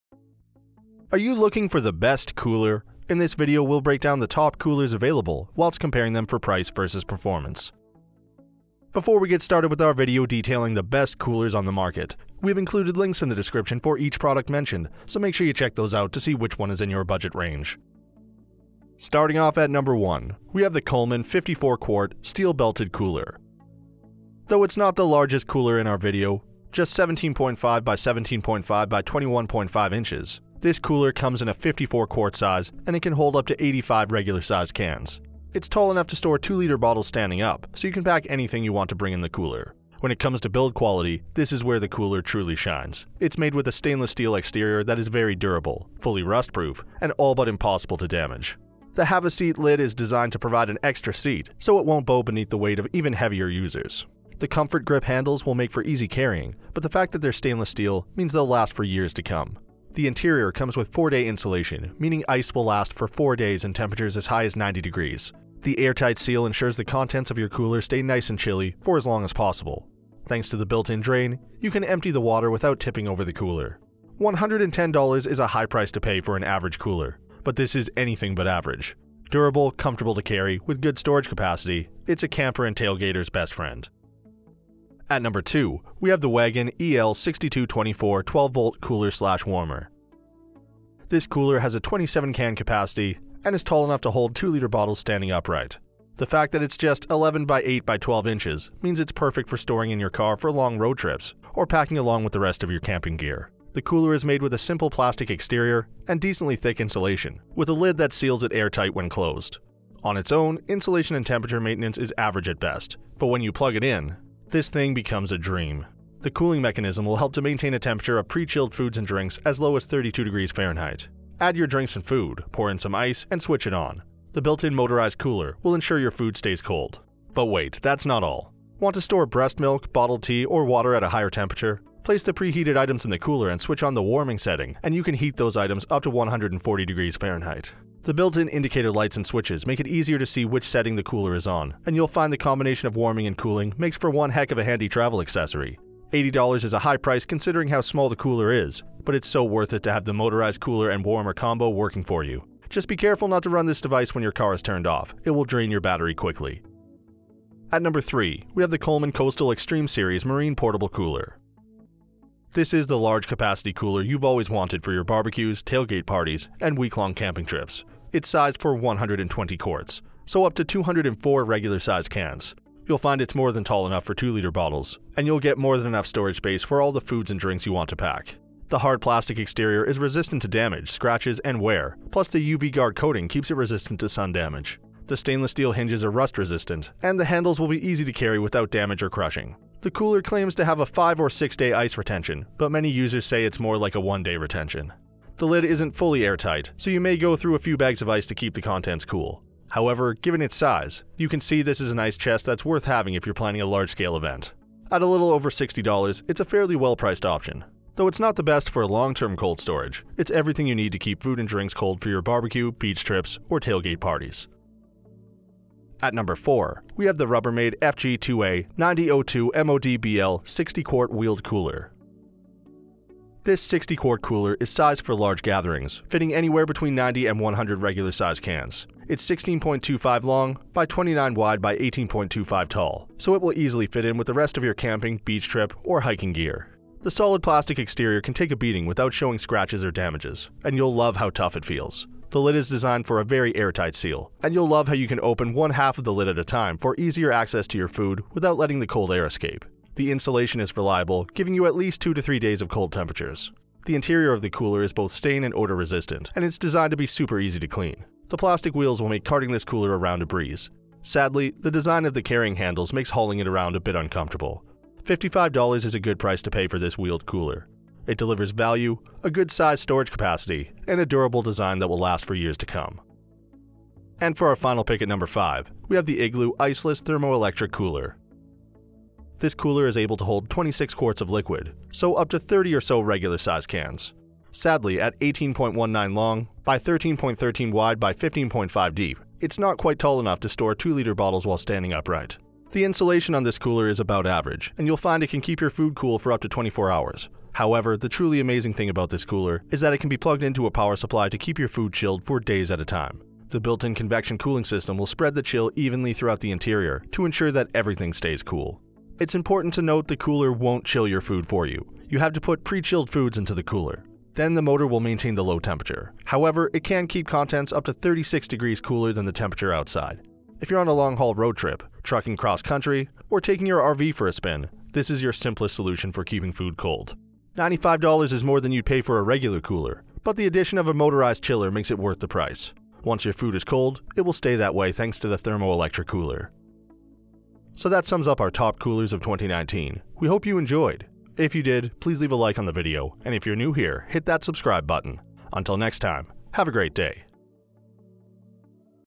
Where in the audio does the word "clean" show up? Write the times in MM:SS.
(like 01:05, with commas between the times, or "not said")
04:17.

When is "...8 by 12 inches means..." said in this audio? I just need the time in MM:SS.
01:37.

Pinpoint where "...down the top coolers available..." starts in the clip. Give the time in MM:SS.
00:03.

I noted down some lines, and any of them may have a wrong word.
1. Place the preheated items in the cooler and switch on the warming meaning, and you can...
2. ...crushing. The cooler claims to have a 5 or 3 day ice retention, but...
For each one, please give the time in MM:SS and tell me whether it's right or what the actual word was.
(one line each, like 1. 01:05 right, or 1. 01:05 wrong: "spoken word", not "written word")
1. 02:12 wrong: "setting", not "meaning"
2. 03:09 wrong: "6", not "3".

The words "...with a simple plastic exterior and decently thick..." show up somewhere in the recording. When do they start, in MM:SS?
01:44.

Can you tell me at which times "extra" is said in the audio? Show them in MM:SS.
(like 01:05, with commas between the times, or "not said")
00:50.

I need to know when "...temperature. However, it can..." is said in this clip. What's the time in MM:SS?
05:15.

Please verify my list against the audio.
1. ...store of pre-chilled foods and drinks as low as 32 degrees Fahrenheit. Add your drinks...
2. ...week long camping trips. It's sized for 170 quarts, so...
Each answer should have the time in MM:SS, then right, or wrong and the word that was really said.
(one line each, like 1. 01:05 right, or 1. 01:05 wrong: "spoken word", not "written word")
1. 01:57 wrong: "temperature", not "store"
2. 02:46 wrong: "120", not "170".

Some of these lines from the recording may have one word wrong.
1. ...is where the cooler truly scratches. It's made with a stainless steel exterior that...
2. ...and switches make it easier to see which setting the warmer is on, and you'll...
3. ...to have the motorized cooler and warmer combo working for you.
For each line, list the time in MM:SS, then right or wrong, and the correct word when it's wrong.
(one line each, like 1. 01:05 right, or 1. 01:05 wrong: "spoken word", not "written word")
1. 00:41 wrong: "shines", not "scratches"
2. 02:19 wrong: "cooler", not "warmer"
3. 02:29 right.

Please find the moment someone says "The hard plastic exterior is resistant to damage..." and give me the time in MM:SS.
02:58.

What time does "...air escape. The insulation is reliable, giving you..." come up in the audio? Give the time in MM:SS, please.
04:09.